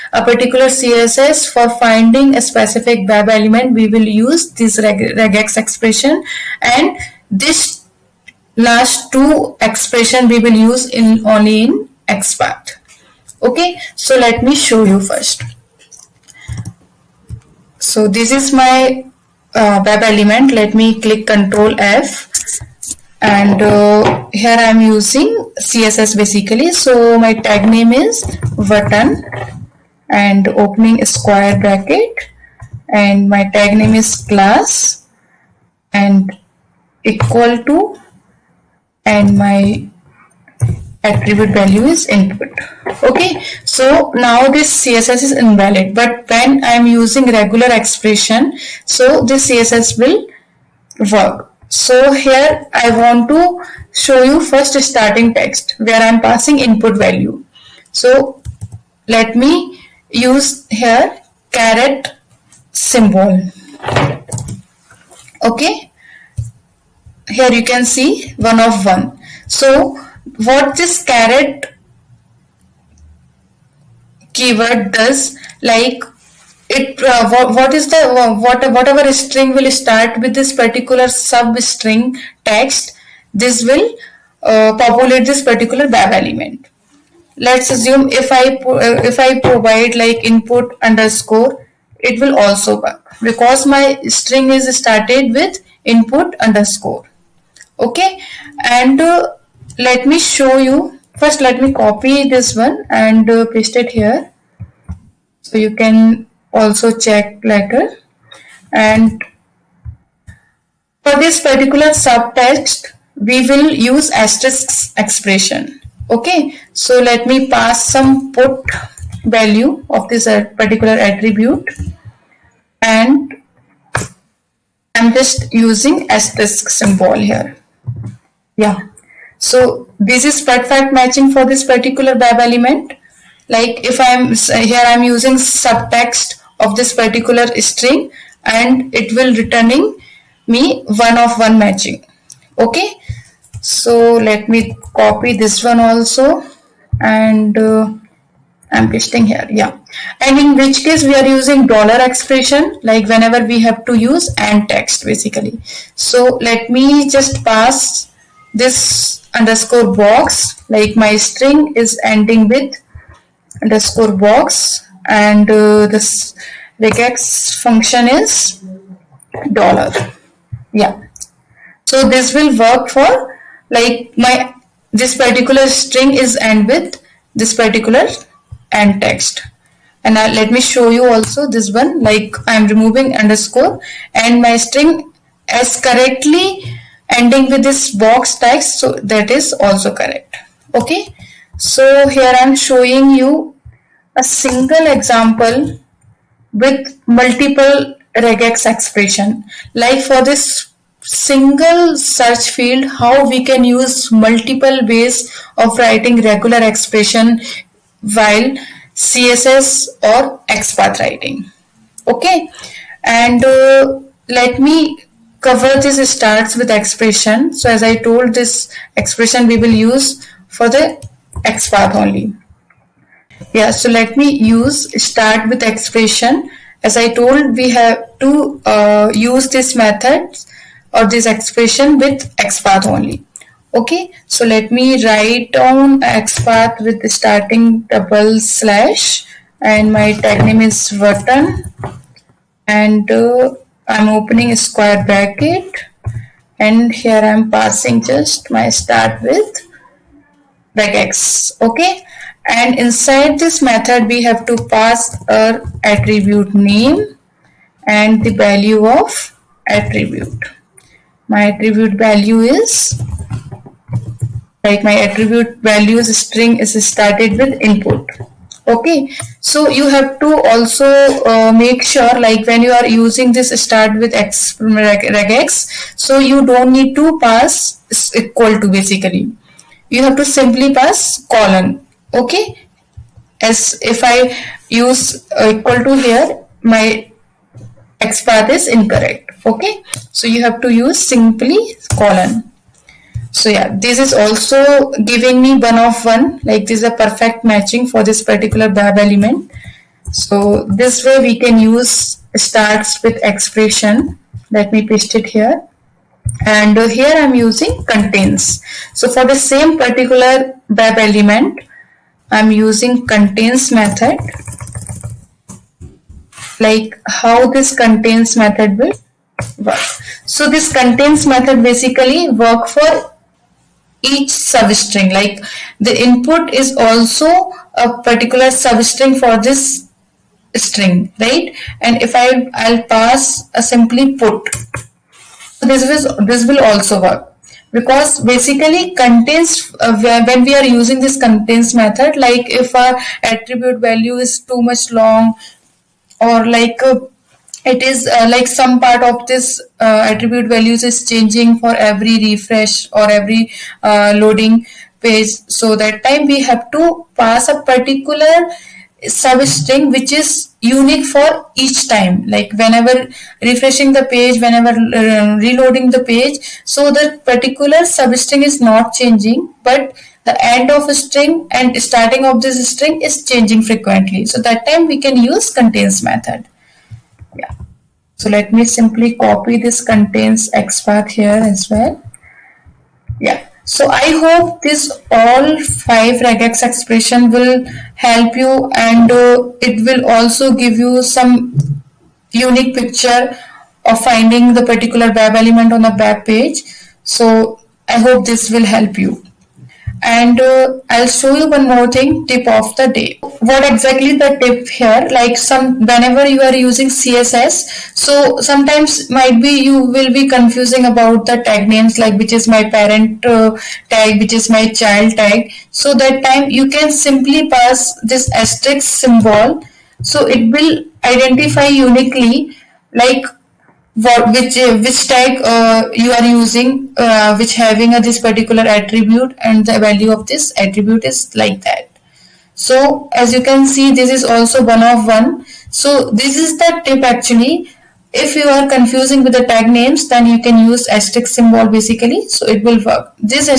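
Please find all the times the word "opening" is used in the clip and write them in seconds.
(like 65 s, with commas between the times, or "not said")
30 s, 244 s.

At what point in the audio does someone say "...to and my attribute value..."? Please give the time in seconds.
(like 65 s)
37 s.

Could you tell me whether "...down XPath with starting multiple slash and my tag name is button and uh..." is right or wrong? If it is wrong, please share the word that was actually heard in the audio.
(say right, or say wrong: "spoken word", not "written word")
wrong: "double", not "multiple".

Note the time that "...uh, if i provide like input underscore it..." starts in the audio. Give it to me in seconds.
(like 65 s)
88 s.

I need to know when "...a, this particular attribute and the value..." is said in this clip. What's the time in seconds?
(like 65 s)
427 s.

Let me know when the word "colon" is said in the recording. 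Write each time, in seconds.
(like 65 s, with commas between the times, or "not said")
281 s, 291 s.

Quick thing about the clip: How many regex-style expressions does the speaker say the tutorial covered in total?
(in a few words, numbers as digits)
5.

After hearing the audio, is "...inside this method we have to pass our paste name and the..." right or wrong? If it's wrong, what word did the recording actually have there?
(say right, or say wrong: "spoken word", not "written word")
wrong: "attribute", not "paste".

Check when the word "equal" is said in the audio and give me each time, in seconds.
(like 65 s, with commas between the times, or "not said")
37 s, 278 s, 285 s.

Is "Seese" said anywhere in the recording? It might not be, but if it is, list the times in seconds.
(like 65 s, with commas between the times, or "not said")
not said.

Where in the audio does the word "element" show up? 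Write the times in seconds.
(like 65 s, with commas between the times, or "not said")
3 s, 20 s, 86 s, 132 s, 298 s, 310 s, 395 s.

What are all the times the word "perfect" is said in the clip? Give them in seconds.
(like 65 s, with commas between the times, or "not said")
130 s, 296 s.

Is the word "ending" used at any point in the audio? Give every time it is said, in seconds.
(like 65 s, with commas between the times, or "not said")
162 s, 187 s.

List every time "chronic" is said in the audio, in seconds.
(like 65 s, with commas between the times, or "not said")
not said.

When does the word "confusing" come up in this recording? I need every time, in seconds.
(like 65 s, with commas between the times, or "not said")
410 s, 438 s.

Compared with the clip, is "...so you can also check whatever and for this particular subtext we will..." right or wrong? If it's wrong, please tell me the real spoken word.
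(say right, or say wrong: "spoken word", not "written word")
wrong: "later", not "whatever".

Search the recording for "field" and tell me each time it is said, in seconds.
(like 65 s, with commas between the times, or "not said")
202 s.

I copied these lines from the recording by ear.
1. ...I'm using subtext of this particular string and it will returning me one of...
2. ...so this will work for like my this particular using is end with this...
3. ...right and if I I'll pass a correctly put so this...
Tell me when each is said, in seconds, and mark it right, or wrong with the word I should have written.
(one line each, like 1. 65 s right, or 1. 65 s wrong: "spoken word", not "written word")
1. 134 s right
2. 171 s wrong: "string", not "using"
3. 331 s wrong: "simply", not "correctly".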